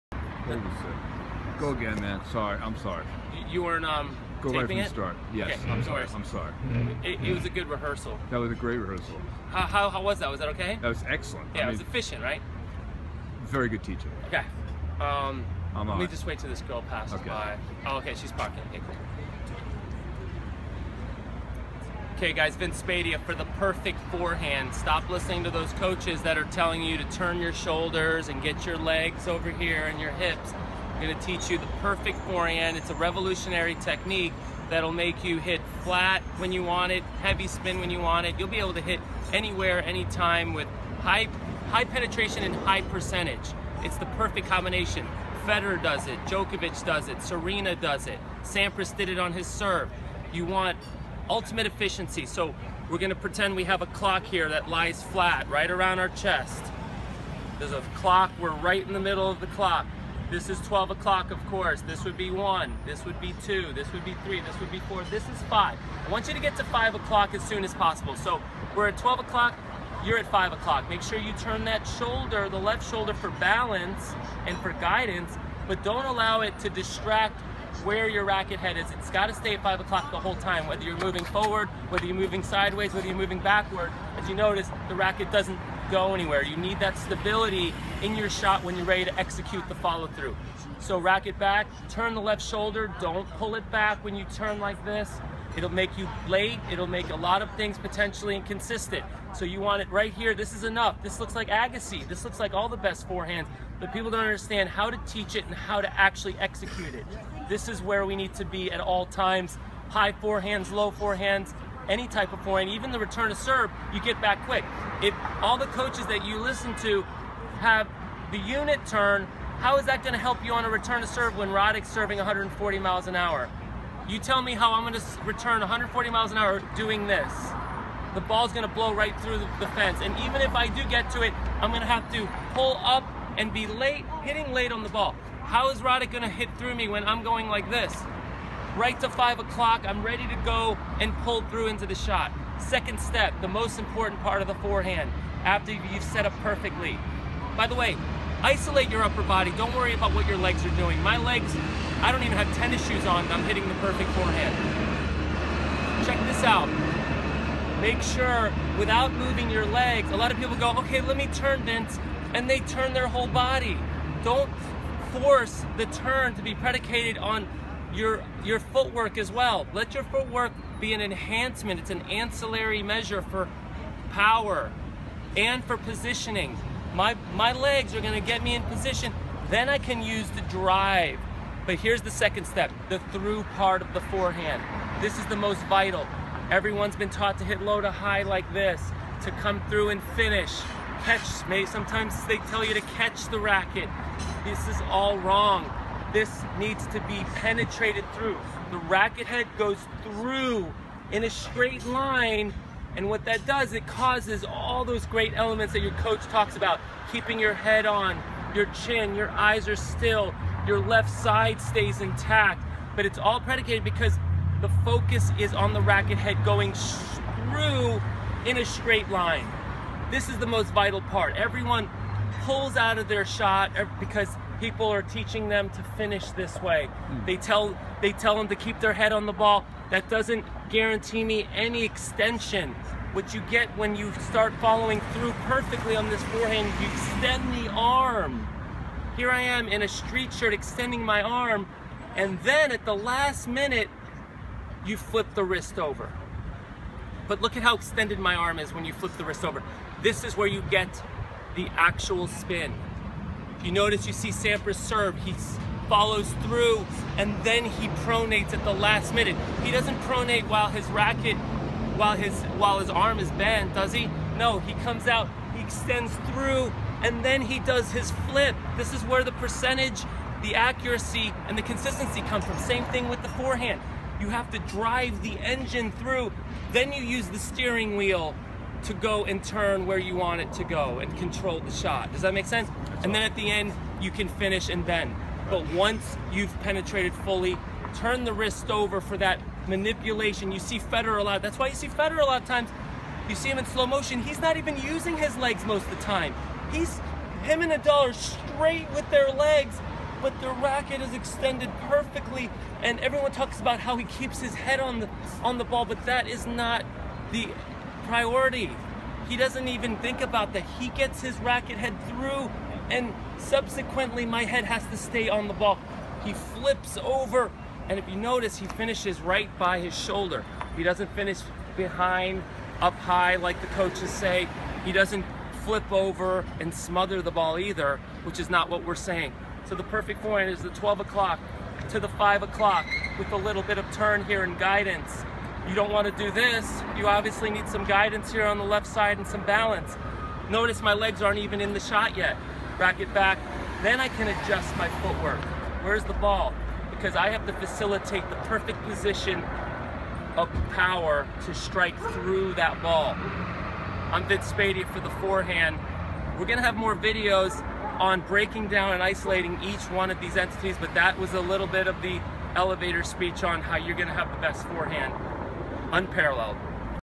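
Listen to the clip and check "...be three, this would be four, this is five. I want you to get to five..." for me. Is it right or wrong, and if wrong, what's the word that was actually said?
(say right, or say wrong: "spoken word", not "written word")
right.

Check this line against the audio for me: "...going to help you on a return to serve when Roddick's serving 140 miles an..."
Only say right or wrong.
right.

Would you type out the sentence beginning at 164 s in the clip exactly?
Don't force the turn to be predicated on your, your footwork as well.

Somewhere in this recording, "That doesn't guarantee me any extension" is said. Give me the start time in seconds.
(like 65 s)
229 s.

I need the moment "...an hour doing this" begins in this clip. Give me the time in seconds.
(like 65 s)
126 s.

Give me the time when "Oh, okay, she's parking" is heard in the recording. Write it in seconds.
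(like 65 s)
17 s.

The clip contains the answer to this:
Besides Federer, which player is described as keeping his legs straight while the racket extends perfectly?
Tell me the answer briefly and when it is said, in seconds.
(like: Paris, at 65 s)
Nadal, at 297 s.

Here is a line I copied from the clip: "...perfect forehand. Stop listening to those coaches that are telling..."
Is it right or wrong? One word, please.
right.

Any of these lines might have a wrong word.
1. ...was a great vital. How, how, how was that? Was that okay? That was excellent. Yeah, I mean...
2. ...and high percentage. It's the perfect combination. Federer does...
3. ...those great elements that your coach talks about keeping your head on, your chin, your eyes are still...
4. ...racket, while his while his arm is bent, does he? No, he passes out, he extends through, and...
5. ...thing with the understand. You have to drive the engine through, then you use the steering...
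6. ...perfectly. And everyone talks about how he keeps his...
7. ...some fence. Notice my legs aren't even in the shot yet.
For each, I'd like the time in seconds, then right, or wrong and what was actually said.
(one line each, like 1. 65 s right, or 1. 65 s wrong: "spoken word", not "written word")
1. 8 s wrong: "rehearsal", not "vital"
2. 42 s right
3. 204 s right
4. 260 s wrong: "comes", not "passes"
5. 272 s wrong: "forehand", not "understand"
6. 301 s right
7. 339 s wrong: "balance", not "fence".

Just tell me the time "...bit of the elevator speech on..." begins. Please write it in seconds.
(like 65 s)
361 s.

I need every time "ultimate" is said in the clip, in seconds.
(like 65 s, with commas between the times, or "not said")
51 s.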